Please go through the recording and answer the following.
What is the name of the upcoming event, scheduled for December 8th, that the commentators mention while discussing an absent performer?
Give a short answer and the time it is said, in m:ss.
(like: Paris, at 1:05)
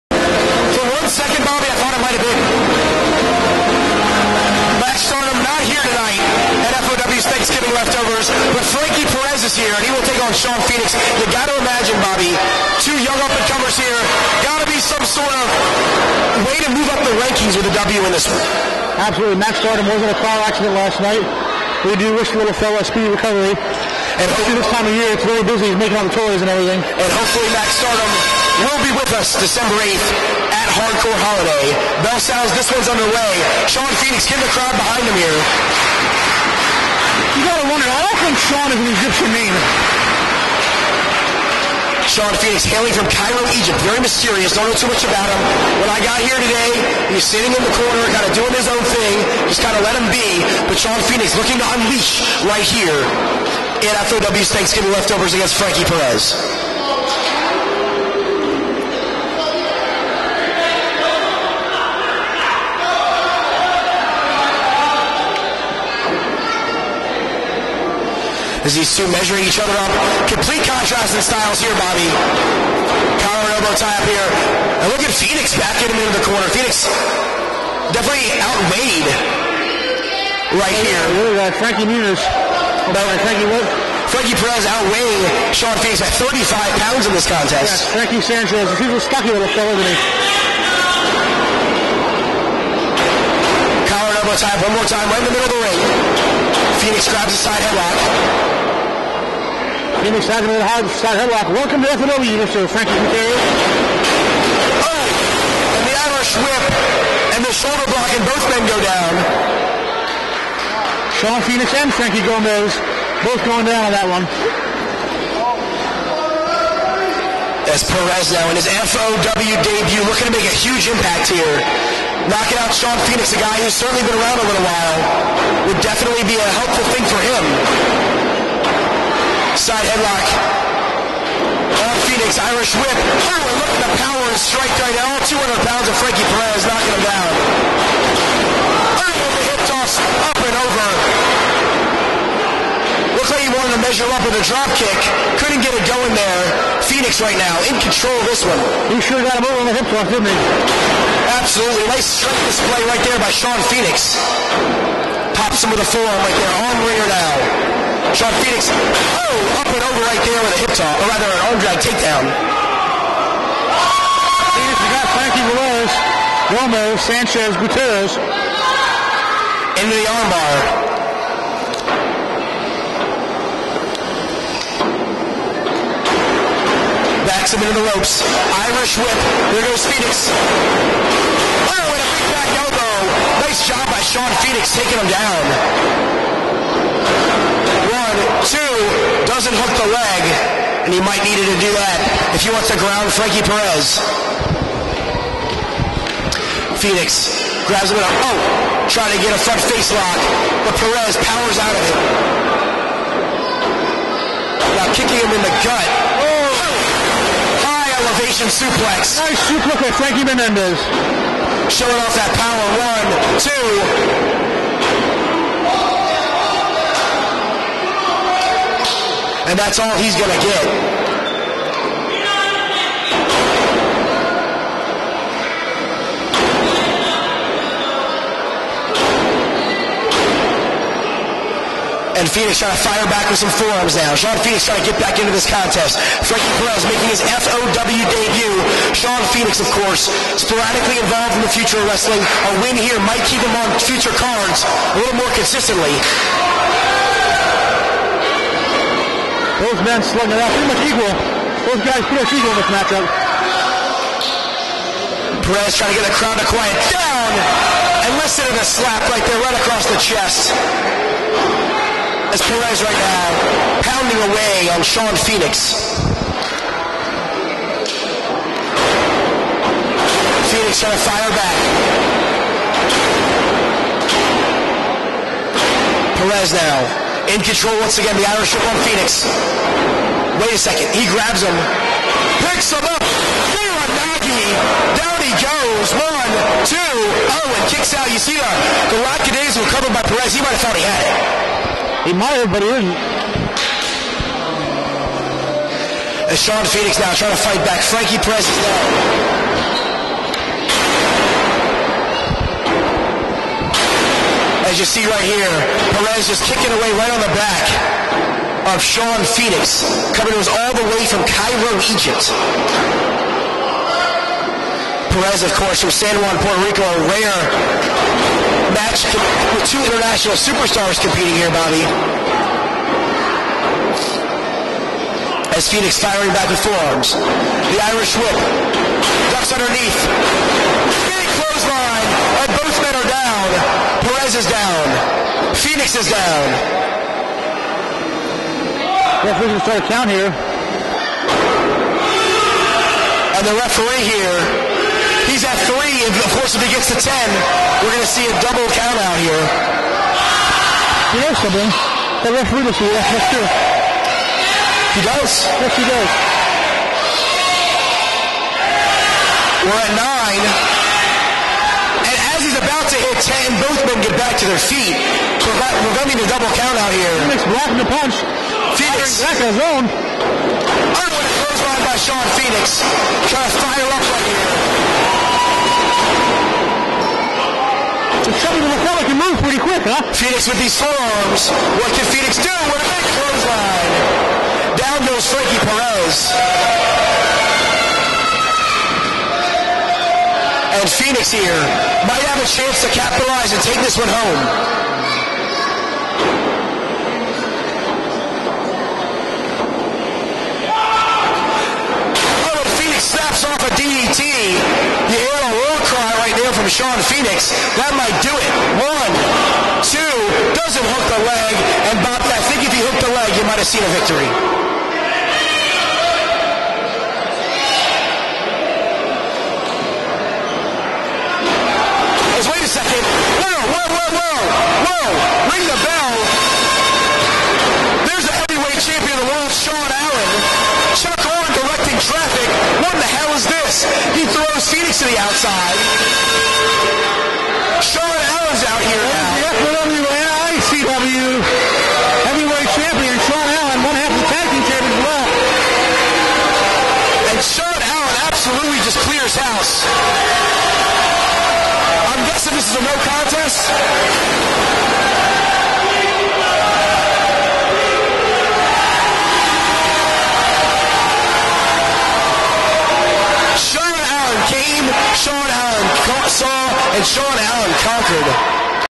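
Hardcore Holiday, at 0:30.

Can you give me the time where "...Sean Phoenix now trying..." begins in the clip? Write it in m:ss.
4:56.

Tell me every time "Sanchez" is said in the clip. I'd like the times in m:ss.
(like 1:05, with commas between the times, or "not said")
1:28, 2:46.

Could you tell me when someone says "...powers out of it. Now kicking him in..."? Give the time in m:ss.
3:21.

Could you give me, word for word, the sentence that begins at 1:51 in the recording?
Sean Phoenix and Frankie Gomez both going down on that one.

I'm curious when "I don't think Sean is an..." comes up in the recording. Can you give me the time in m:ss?
0:37.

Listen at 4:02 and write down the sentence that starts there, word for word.
A win here might keep him on future cards a little more consistently.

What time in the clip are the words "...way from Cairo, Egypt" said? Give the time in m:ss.
5:10.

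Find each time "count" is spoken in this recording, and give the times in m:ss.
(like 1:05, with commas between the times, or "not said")
5:39, 5:48, 6:06.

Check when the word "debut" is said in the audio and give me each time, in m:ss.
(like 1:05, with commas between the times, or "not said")
1:59, 3:57.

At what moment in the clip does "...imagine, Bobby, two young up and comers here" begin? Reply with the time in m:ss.
0:11.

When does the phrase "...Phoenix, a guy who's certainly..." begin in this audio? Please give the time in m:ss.
2:03.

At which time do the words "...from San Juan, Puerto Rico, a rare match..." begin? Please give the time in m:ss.
5:15.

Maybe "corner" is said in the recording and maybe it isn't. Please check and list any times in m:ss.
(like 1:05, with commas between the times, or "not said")
0:47, 1:16.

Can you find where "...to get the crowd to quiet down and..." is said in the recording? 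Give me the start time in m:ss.
4:15.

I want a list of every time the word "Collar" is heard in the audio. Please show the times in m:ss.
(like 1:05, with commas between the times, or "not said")
1:13, 1:33.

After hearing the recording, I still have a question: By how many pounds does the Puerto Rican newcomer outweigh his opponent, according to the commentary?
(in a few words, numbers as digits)
35.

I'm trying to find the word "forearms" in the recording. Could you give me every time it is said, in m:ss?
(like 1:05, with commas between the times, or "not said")
2:35, 3:53, 5:26, 6:20.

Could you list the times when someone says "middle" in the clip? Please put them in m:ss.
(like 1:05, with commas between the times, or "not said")
1:35.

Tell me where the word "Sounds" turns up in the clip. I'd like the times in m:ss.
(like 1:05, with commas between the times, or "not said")
0:32.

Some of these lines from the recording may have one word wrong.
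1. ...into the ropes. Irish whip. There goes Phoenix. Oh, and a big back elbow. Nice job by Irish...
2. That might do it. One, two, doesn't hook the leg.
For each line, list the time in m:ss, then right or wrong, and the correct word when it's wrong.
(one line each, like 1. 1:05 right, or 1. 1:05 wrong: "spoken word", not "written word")
1. 2:57 wrong: "Sean", not "Irish"
2. 6:47 right.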